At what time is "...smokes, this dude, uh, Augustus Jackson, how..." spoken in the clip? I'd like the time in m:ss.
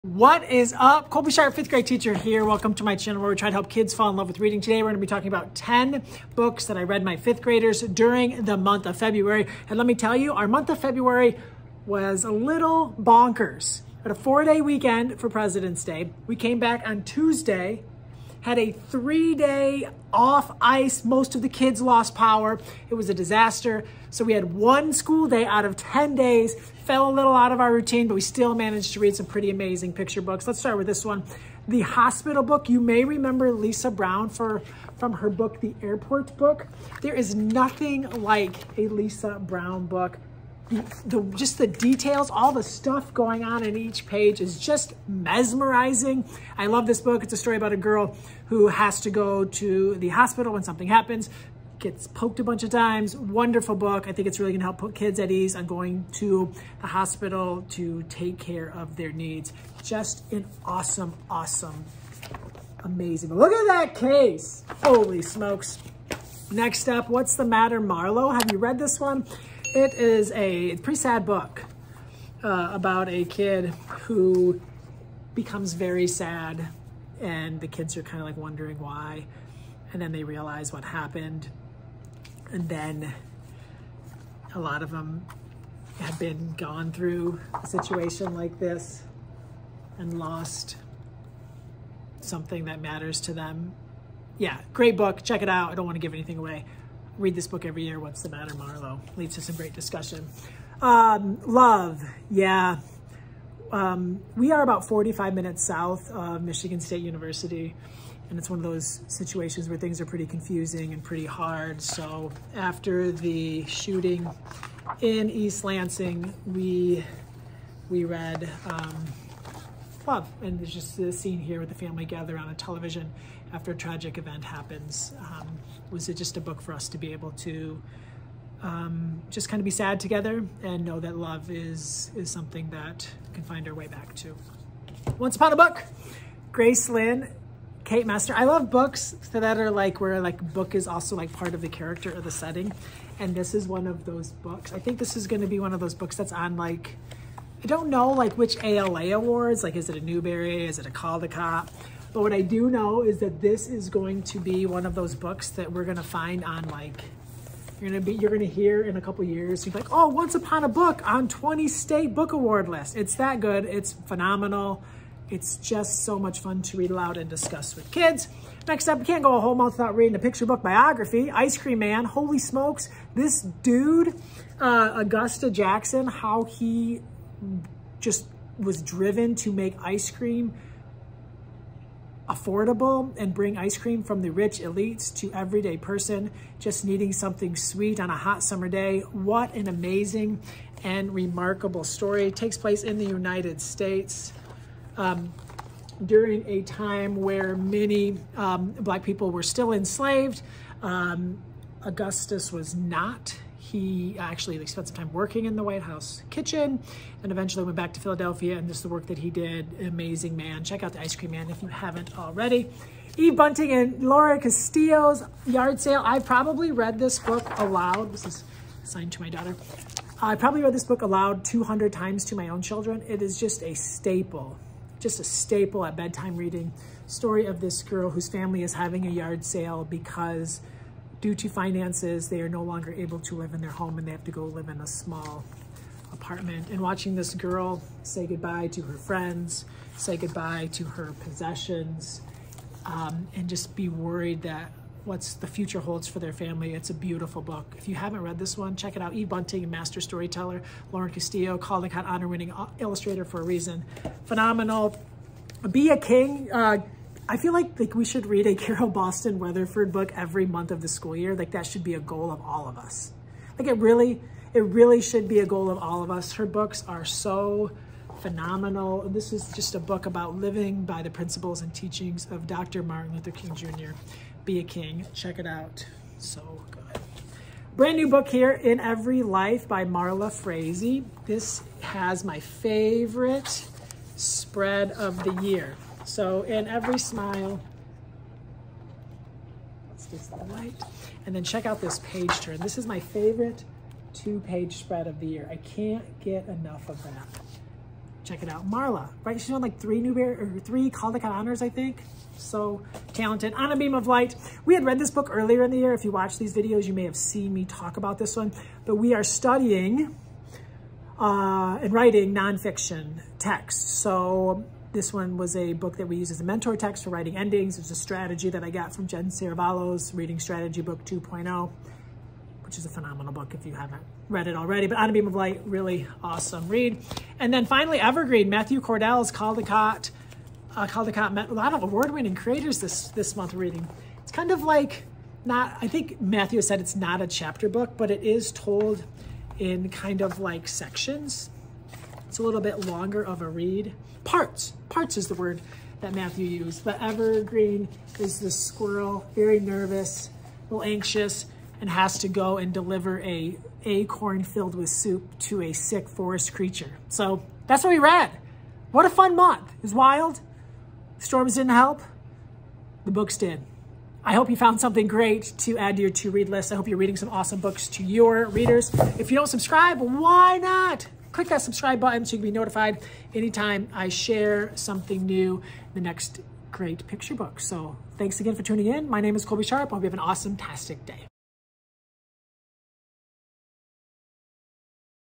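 2:52.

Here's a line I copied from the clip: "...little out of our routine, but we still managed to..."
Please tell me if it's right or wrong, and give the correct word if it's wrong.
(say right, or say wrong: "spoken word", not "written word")
right.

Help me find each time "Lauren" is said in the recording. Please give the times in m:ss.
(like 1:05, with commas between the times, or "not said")
3:34, 4:10.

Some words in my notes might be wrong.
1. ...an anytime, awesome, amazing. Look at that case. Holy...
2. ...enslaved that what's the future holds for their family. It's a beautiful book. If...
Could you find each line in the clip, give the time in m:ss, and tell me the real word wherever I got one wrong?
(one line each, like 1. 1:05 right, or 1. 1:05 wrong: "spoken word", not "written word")
1. 1:00 wrong: "awesome", not "anytime"
2. 4:03 wrong: "worried", not "enslaved".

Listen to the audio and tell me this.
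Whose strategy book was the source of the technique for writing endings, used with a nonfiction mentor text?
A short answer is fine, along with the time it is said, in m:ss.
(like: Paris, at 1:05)
Jen Serravallo, at 5:19.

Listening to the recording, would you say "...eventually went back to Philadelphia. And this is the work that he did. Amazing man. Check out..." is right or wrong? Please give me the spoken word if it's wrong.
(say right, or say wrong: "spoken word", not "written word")
right.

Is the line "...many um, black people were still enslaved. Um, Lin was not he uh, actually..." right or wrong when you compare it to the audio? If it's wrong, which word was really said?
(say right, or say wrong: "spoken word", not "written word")
wrong: "Augustus", not "Lin".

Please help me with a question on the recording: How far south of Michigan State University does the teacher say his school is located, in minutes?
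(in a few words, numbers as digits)
45 minutes.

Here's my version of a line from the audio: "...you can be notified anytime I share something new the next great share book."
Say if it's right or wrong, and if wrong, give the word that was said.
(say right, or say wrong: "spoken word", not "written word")
wrong: "picture", not "share".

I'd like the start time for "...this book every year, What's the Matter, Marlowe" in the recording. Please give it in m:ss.
1:37.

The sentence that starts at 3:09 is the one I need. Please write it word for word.
What an amazing and remarkable story.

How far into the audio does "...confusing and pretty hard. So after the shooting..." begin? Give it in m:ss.
1:50.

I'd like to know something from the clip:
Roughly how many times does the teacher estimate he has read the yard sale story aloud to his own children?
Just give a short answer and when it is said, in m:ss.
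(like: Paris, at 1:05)
200, at 3:41.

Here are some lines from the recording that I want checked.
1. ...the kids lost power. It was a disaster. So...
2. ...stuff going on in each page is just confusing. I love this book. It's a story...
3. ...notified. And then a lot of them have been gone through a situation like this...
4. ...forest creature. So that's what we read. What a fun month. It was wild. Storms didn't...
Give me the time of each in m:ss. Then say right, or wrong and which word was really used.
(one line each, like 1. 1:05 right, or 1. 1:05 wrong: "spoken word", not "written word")
1. 0:21 right
2. 0:42 wrong: "mesmerizing", not "confusing"
3. 1:20 wrong: "happened", not "notified"
4. 5:56 right.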